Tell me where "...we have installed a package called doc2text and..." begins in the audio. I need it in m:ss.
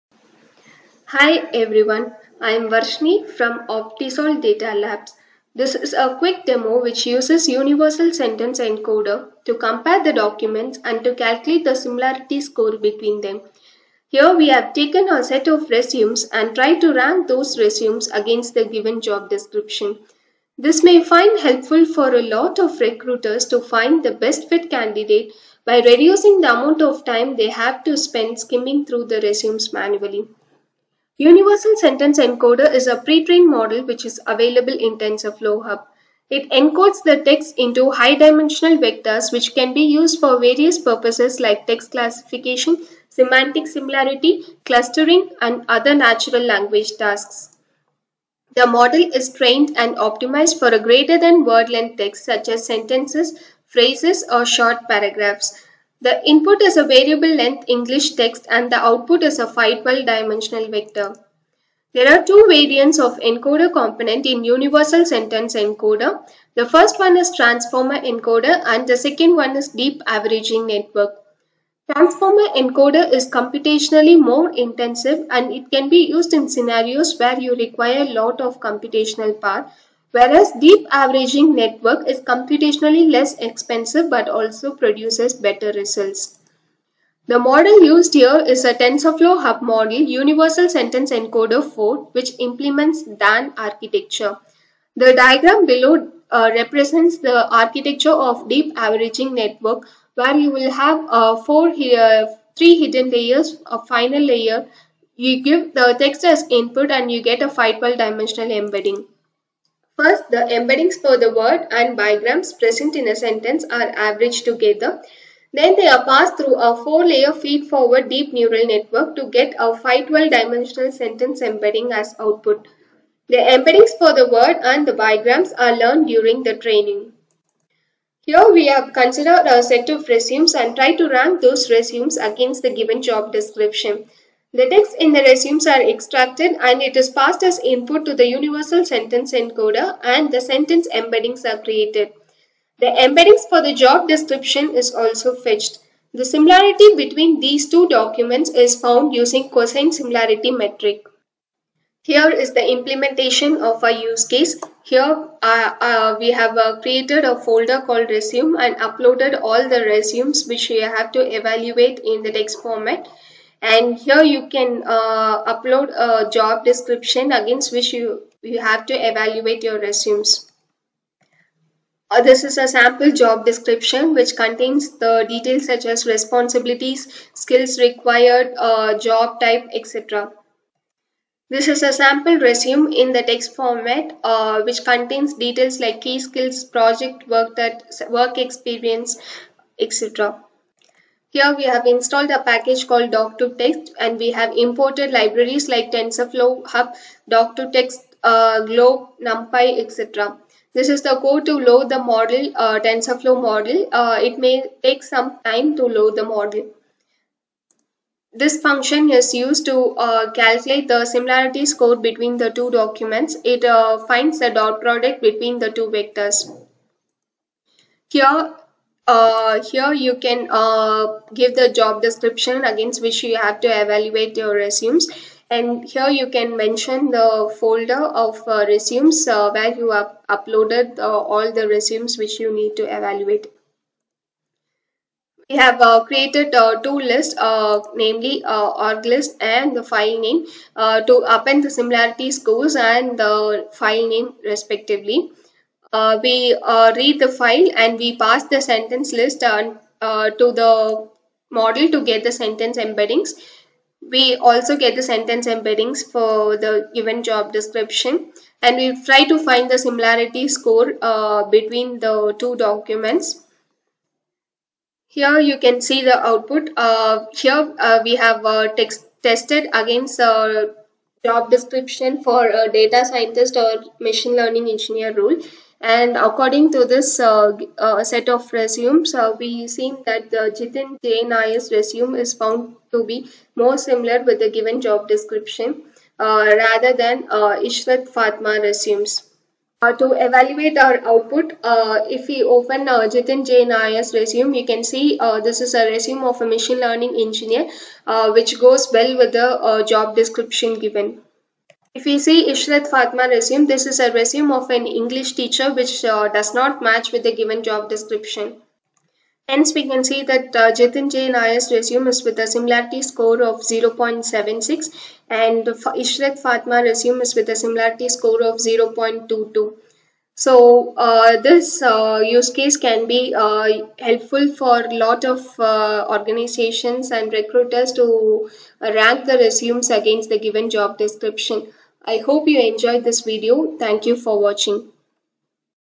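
3:11.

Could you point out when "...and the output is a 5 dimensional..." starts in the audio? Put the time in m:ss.
0:58.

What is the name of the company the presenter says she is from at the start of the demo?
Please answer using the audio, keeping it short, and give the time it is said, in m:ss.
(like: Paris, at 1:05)
Optisol Data Labs, at 0:03.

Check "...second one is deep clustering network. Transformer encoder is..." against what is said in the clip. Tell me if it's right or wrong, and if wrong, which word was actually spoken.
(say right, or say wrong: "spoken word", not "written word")
wrong: "averaging", not "clustering".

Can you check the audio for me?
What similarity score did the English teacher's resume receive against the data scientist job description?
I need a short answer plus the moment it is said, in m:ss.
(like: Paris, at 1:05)
0.22, at 5:18.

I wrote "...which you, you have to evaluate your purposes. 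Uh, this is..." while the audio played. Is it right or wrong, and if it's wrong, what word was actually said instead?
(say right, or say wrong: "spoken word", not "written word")
wrong: "resumes", not "purposes".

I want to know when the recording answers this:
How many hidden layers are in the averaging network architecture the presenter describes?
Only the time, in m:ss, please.
1:42.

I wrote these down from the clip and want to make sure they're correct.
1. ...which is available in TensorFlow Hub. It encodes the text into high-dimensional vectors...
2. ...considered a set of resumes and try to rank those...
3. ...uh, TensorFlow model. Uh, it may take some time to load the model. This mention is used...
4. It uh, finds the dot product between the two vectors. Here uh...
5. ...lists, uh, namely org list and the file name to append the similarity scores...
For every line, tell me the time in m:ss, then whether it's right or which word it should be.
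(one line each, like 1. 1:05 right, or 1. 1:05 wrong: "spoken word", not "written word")
1. 0:33 right
2. 2:08 right
3. 3:22 wrong: "function", not "mention"
4. 3:33 right
5. 3:56 right.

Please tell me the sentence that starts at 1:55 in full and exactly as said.
Then they are passed through a four-layer feed-forward deep neural network to get a 512-dimensional sentence embedding as output.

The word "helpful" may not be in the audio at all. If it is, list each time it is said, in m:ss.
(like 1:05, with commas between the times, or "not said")
0:21, 5:23.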